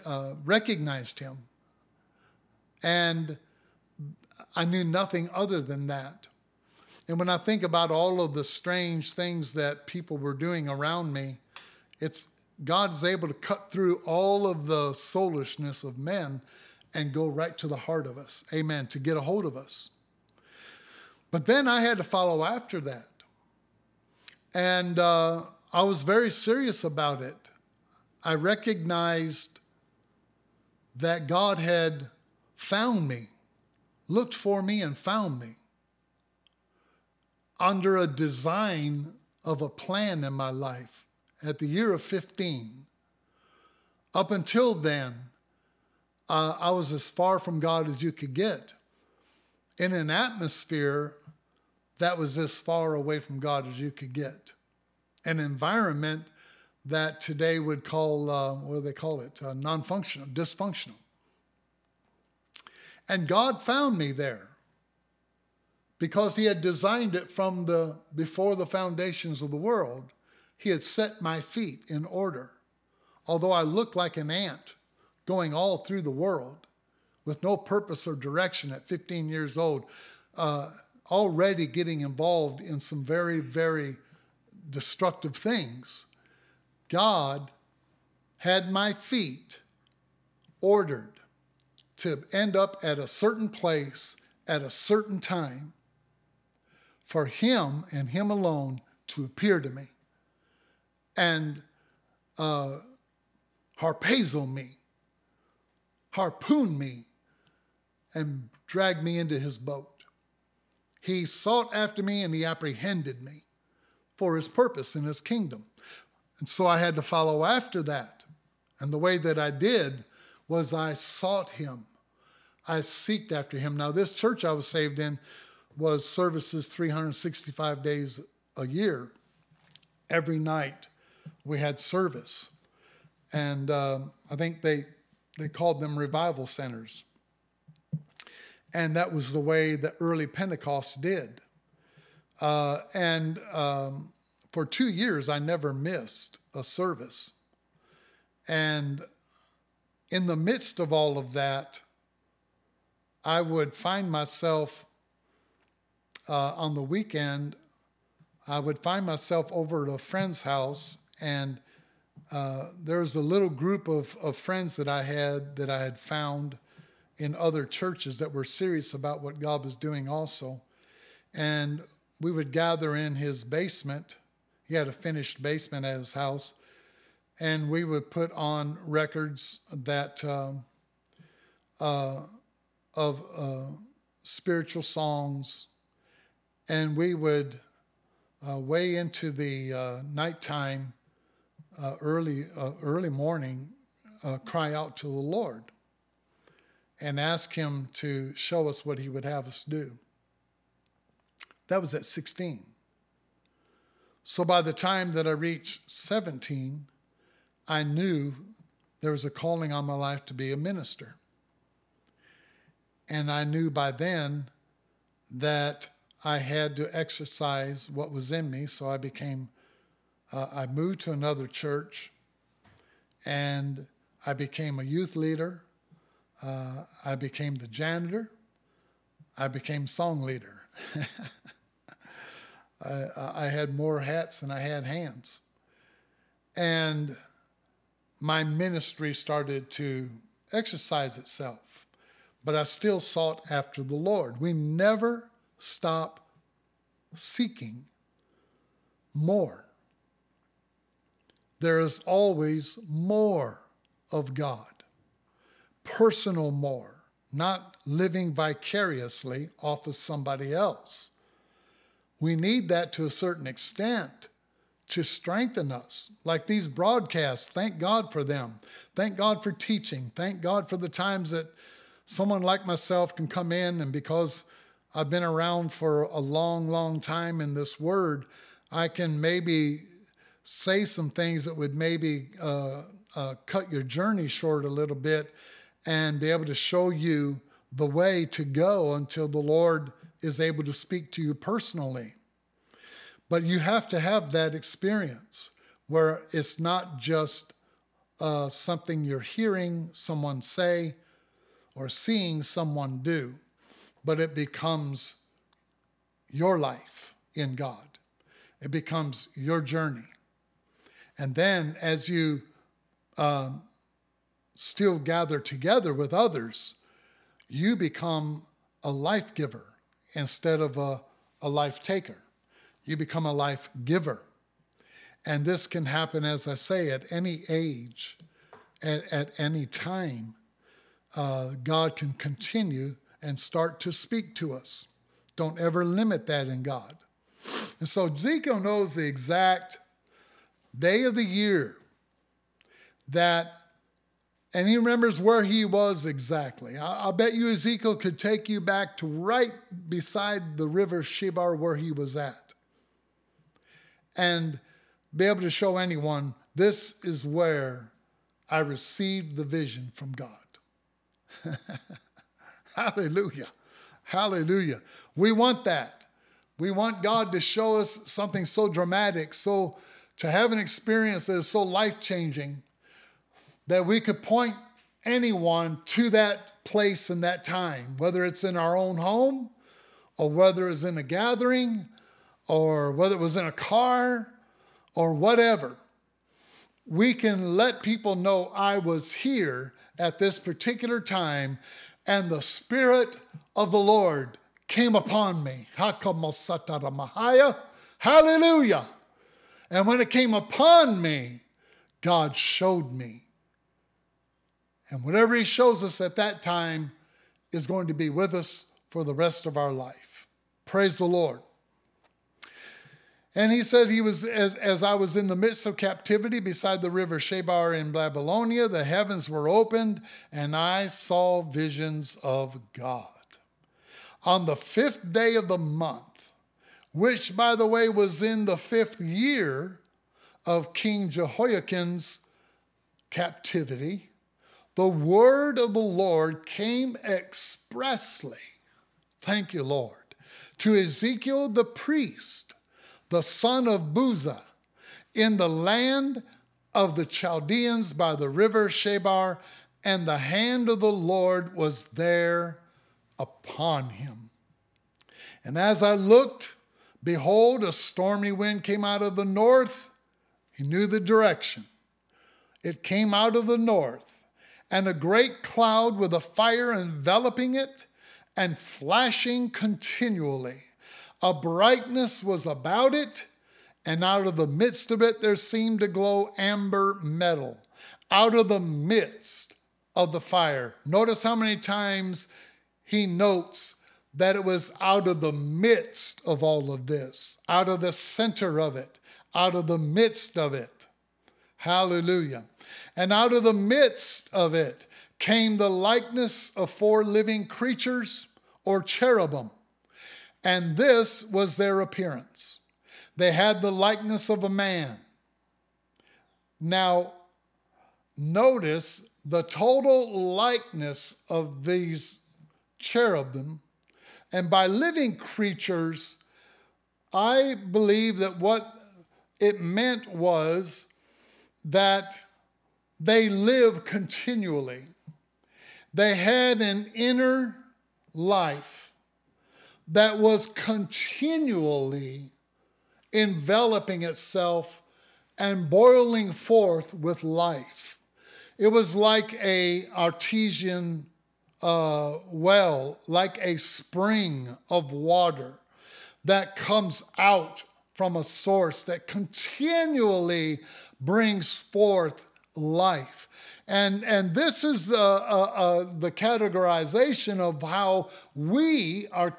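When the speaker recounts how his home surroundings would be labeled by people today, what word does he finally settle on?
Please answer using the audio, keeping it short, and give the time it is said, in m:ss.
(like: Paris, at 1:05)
dysfunctional, at 1:00.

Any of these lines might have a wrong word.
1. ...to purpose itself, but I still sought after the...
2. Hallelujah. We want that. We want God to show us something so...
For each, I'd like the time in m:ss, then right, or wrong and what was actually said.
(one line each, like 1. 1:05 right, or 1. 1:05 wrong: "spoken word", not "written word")
1. 3:59 wrong: "exercise", not "purpose"
2. 6:04 right.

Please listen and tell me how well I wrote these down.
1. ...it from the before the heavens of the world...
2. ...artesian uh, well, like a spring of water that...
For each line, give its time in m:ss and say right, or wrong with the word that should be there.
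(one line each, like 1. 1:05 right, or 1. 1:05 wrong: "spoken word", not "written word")
1. 1:07 wrong: "foundations", not "heavens"
2. 8:59 right.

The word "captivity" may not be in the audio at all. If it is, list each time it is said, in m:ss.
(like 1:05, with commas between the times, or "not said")
6:55, 7:13.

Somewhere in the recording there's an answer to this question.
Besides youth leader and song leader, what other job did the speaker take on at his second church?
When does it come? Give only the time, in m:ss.
3:47.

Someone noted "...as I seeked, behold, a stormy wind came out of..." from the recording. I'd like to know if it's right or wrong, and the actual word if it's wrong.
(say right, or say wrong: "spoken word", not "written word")
wrong: "looked", not "seeked".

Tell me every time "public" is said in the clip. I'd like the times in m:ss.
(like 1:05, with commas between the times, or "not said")
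not said.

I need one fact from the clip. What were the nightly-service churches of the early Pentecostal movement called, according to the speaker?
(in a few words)
revival centers.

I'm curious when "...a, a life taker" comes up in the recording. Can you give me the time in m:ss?
5:20.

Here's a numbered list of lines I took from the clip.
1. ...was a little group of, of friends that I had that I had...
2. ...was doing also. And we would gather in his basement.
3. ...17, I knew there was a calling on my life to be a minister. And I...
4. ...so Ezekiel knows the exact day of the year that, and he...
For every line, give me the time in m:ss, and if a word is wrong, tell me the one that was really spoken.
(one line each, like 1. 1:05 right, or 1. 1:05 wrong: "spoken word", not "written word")
1. 2:42 right
2. 2:49 right
3. 3:25 right
4. 5:37 right.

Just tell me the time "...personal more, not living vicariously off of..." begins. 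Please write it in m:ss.
4:15.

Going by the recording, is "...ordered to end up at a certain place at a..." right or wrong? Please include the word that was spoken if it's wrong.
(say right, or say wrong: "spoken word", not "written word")
right.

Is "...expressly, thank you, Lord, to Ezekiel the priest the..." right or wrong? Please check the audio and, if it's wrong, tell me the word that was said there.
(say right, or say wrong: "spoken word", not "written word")
right.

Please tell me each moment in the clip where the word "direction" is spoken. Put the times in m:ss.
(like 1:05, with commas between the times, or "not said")
1:18, 7:40.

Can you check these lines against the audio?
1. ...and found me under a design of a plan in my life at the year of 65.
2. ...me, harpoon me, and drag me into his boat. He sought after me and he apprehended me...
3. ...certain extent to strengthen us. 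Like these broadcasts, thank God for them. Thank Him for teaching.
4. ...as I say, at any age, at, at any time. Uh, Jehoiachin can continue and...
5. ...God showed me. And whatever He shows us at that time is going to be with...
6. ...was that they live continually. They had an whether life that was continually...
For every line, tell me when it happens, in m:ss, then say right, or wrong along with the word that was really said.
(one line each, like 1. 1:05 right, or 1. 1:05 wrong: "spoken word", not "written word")
1. 0:34 wrong: "15", not "65"
2. 1:44 right
3. 4:23 wrong: "God", not "Him"
4. 5:26 wrong: "God", not "Jehoiachin"
5. 6:41 right
6. 8:40 wrong: "inner", not "whether".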